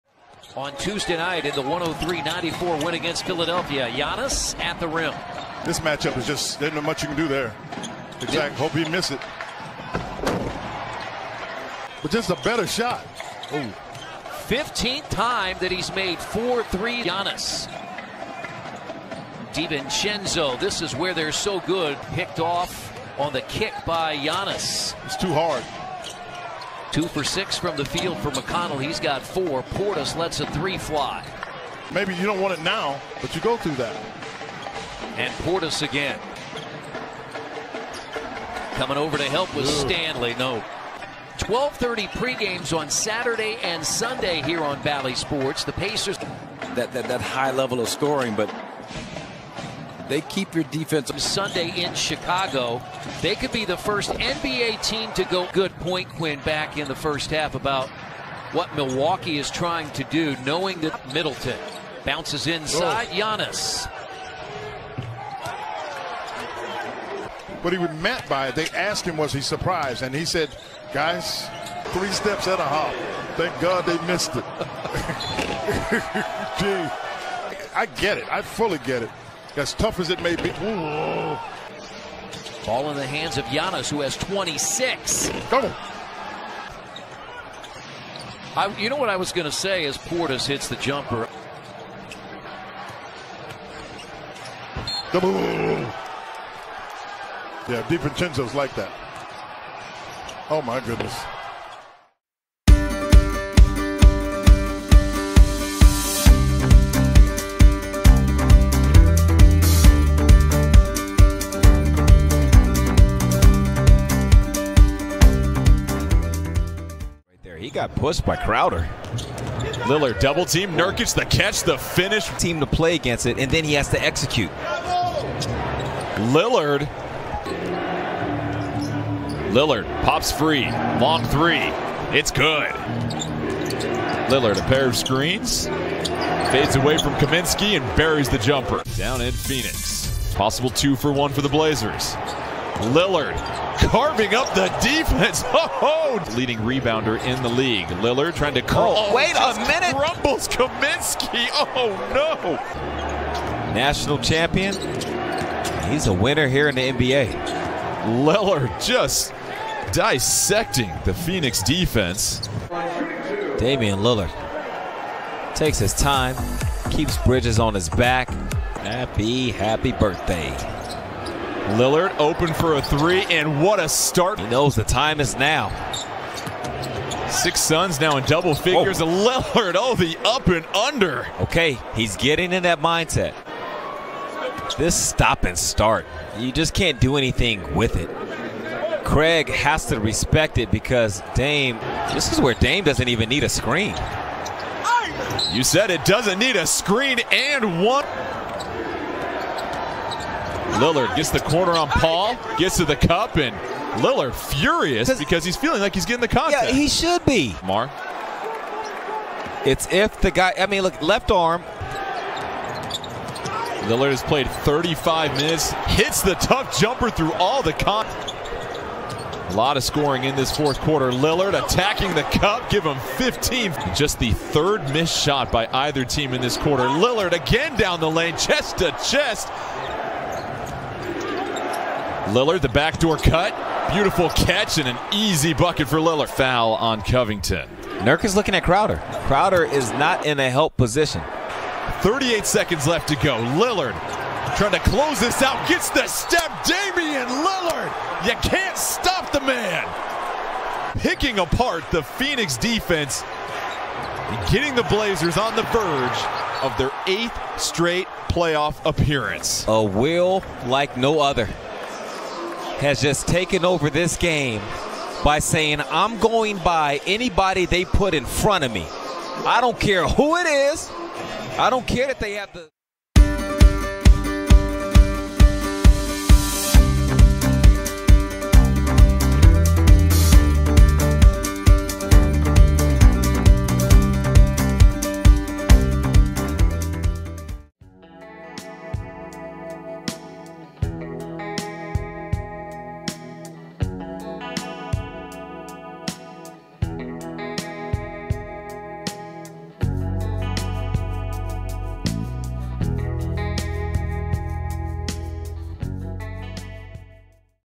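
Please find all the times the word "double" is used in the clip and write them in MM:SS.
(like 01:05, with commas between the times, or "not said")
01:25, 01:35, 02:00, 02:58.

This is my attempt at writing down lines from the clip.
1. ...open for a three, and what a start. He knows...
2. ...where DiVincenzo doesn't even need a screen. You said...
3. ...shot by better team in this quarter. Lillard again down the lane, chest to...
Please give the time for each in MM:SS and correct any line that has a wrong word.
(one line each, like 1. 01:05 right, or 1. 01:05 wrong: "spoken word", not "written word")
1. 02:52 right
2. 03:12 wrong: "Dame", not "DiVincenzo"
3. 03:45 wrong: "either", not "better".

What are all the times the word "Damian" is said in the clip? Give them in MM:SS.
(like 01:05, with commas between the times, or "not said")
02:43, 04:06.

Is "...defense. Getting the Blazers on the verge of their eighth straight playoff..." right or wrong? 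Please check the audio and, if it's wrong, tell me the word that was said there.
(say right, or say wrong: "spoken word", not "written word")
right.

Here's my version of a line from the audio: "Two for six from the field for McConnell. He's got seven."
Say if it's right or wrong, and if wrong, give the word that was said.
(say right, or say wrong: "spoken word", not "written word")
wrong: "four", not "seven".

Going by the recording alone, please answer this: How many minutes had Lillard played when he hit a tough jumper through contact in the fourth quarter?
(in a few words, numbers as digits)
35.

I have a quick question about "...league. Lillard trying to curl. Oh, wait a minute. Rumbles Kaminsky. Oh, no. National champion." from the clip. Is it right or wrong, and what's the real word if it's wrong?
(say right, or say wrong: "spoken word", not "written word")
right.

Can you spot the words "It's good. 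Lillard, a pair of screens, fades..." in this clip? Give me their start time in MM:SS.
02:12.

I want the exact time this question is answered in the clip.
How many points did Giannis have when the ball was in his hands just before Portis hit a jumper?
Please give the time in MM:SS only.
01:24.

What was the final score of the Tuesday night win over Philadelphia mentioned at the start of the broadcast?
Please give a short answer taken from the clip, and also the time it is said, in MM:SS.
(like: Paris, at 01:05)
103-94, at 00:01.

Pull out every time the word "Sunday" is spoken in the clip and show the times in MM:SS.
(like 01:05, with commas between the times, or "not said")
00:43, 00:51.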